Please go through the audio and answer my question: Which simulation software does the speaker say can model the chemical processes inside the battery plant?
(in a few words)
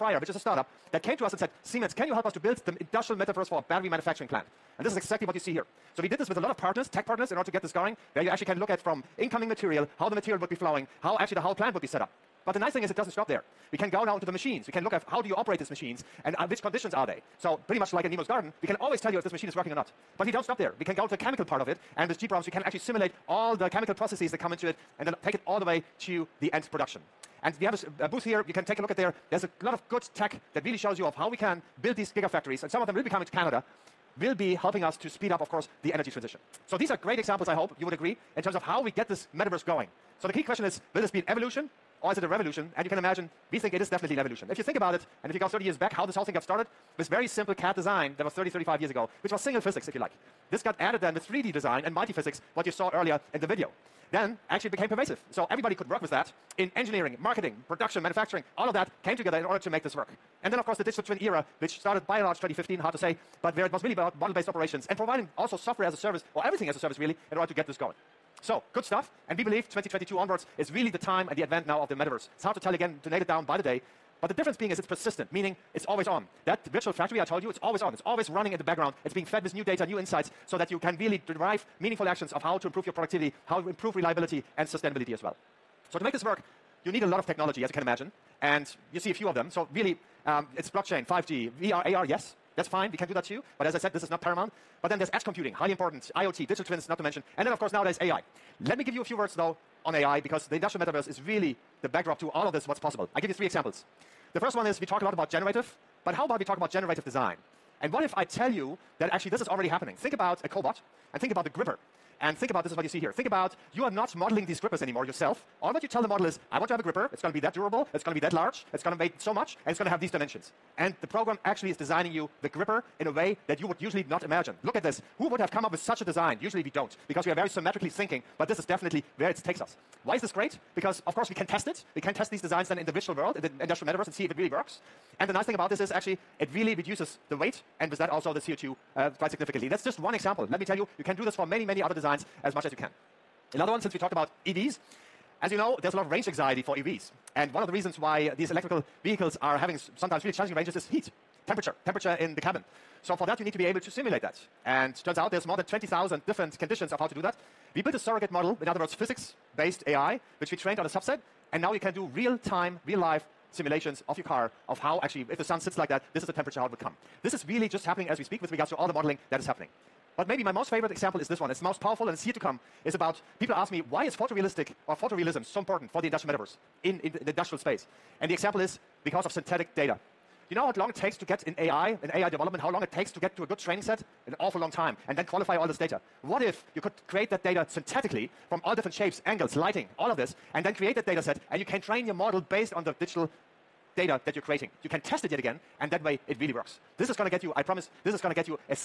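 gPROMS.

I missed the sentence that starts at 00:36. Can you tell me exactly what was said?
So these are great examples, I hope you would agree, in terms of how we get this metaverse going.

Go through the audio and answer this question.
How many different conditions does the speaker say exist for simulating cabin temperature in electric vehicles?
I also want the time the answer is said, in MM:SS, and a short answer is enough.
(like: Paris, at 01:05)
20,000, at 02:35.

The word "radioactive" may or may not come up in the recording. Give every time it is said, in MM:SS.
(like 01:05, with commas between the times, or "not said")
not said.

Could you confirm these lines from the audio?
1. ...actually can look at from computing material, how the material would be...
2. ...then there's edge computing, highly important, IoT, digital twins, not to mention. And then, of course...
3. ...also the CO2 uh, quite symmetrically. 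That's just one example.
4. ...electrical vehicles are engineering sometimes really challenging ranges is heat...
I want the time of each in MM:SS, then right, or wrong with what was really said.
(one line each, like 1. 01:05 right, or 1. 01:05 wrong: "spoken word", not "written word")
1. 00:08 wrong: "incoming", not "computing"
2. 01:34 right
3. 02:18 wrong: "significantly", not "symmetrically"
4. 02:28 wrong: "having", not "engineering".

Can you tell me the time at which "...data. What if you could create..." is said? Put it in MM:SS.
03:05.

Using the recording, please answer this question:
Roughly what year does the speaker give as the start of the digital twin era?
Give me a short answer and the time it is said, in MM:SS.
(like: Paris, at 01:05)
2015, at 01:02.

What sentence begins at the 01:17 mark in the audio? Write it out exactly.
It's always running in the background.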